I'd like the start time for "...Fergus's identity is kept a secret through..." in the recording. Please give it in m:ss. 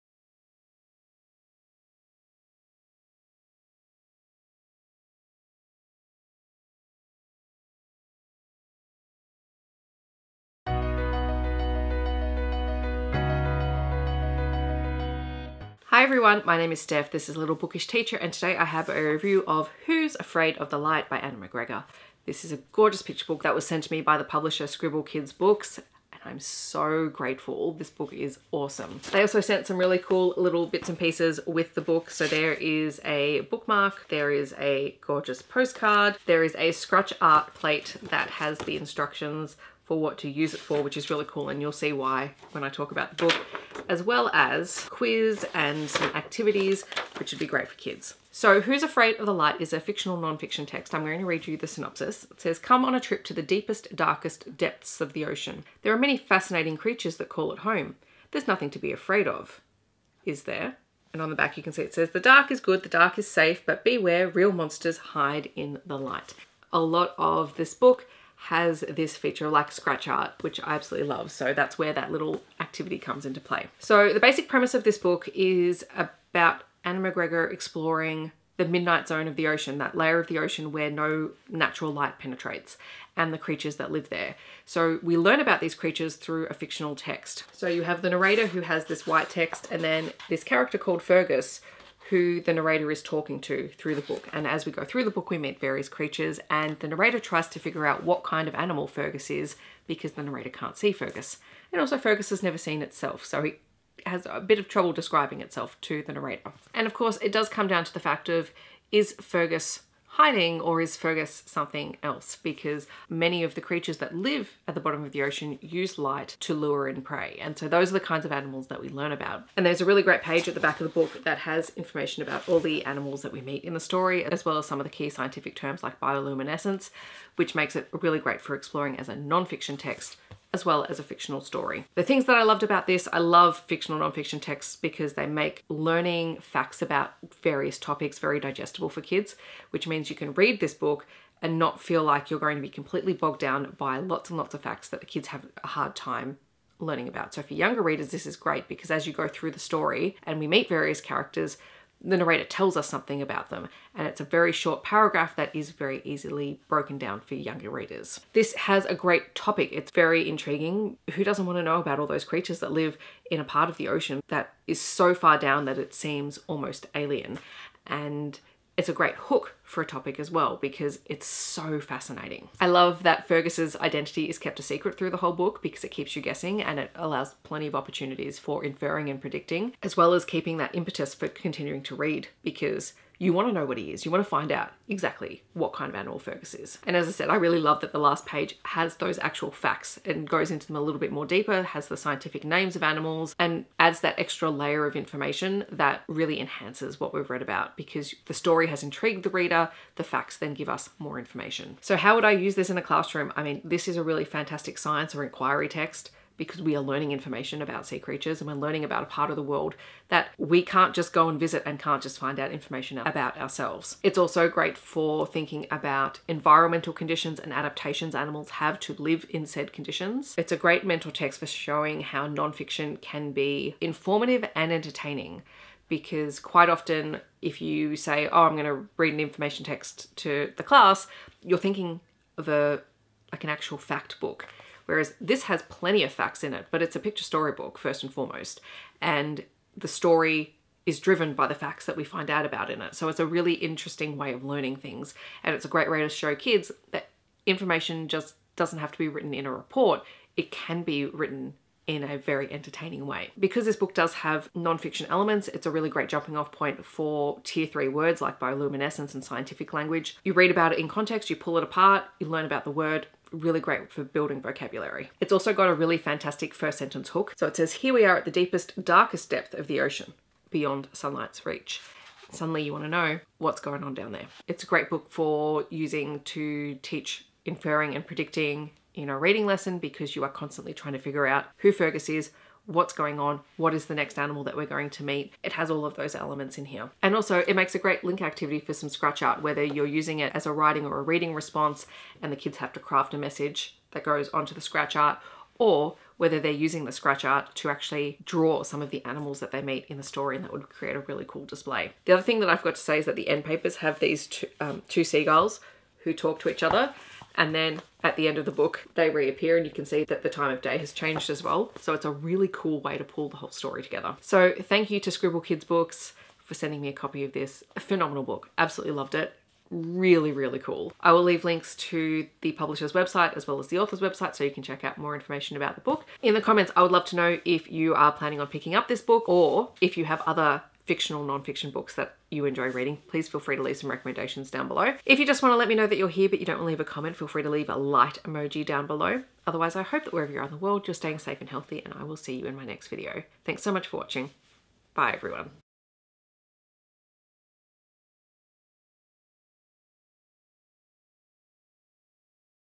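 2:53.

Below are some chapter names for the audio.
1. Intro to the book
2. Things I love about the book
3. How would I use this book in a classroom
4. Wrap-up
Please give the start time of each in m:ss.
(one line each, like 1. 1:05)
1. 0:16
2. 2:11
3. 3:21
4. 5:14.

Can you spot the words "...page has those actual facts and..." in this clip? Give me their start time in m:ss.
3:08.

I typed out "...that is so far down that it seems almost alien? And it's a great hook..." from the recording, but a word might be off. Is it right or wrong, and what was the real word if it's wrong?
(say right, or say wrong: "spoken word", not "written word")
right.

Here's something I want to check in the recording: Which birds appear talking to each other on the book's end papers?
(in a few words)
seagulls.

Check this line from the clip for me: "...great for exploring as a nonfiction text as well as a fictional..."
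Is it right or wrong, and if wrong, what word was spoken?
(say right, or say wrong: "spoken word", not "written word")
right.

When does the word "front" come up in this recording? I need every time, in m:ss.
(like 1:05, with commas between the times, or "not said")
not said.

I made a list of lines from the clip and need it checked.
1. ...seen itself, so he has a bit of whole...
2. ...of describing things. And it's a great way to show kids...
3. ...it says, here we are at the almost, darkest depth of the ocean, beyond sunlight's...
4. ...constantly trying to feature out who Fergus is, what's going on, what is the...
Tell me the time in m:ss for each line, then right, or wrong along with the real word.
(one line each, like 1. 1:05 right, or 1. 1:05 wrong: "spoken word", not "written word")
1. 1:42 wrong: "trouble", not "whole"
2. 4:04 wrong: "learning", not "describing"
3. 4:27 wrong: "deepest", not "almost"
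4. 4:40 wrong: "figure", not "feature".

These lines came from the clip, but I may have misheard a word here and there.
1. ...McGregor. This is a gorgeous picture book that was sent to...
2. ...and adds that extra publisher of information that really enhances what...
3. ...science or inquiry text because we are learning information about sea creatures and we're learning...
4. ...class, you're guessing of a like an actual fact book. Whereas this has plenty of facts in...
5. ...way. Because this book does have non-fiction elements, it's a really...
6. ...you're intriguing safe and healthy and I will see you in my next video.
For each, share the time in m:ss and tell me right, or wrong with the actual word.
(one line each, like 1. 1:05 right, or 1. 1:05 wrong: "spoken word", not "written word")
1. 0:21 right
2. 3:13 wrong: "layer", not "publisher"
3. 3:24 right
4. 3:50 wrong: "thinking", not "guessing"
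5. 4:13 right
6. 5:40 wrong: "staying", not "intriguing".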